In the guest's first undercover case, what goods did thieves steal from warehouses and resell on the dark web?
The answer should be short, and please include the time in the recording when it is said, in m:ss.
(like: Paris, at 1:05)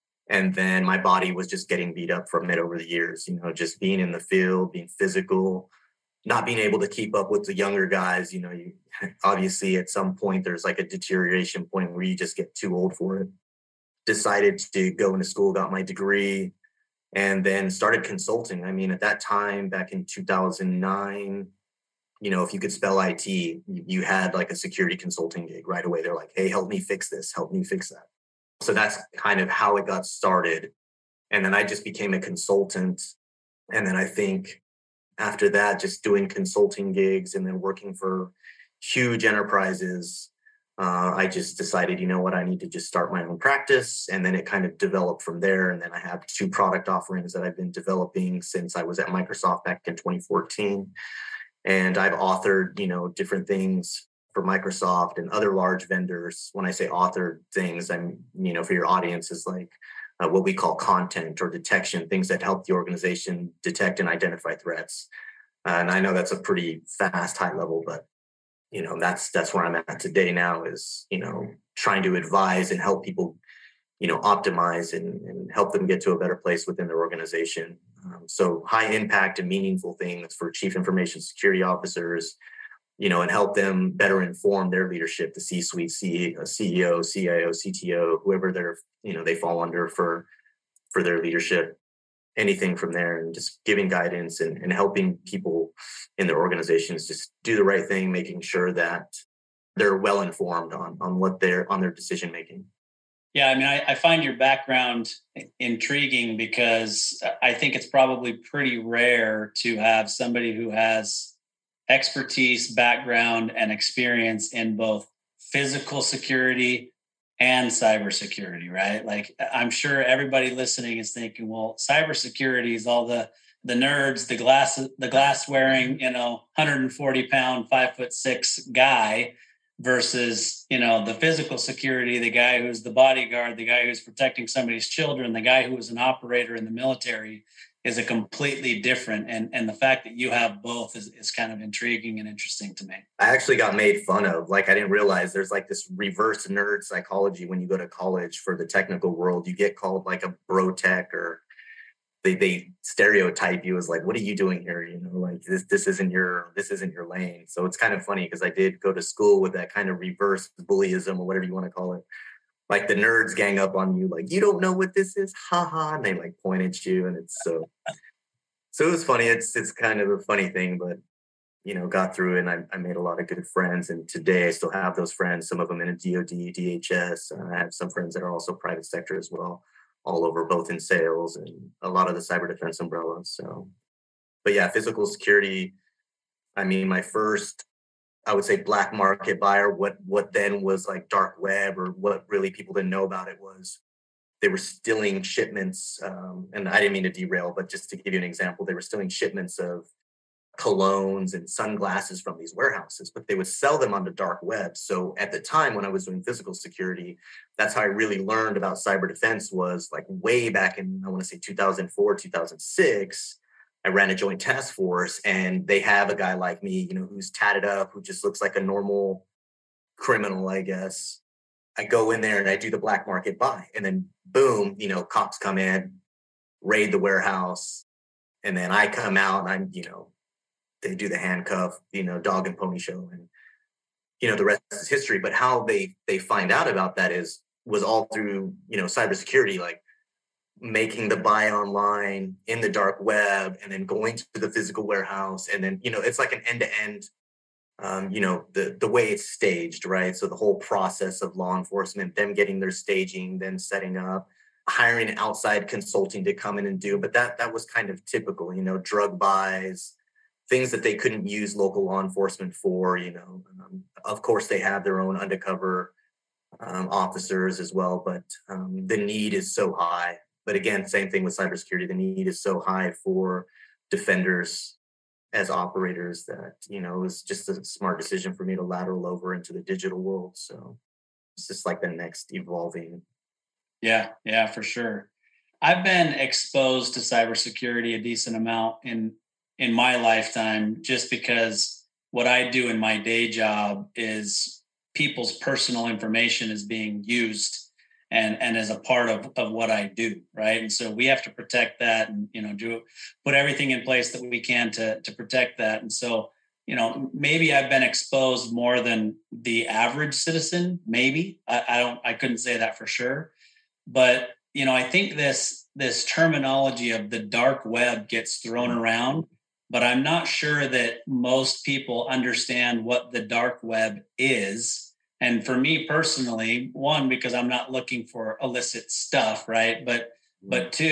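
Colognes and sunglasses, at 3:20.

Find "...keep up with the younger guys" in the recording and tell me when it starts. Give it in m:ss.
0:06.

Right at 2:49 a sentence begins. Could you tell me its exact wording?
It's it's kind of a funny thing, but you know, got through and I, I made a lot of good friends.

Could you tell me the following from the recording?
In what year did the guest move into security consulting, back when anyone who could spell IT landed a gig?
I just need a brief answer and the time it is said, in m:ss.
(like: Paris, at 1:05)
2009, at 0:20.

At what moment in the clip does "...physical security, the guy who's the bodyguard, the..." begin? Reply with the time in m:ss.
2:11.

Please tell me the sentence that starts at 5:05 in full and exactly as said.
And so, you know, maybe I've been exposed more than the average citizen.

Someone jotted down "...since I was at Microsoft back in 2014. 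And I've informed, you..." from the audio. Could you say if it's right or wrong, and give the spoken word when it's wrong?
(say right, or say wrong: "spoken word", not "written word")
wrong: "authored", not "informed".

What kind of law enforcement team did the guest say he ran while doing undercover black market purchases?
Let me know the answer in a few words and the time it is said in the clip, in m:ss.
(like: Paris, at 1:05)
Joint task force, at 3:34.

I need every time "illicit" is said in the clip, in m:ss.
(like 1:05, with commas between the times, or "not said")
5:28.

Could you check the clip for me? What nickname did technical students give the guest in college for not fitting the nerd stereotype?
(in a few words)
Bro tech.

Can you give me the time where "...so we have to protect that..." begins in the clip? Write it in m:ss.
5:00.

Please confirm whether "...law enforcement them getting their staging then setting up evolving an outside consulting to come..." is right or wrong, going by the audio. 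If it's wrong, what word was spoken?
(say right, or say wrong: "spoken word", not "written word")
wrong: "hiring", not "evolving".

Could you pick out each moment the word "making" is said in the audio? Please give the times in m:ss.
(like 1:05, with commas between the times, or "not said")
1:38, 1:42, 4:00.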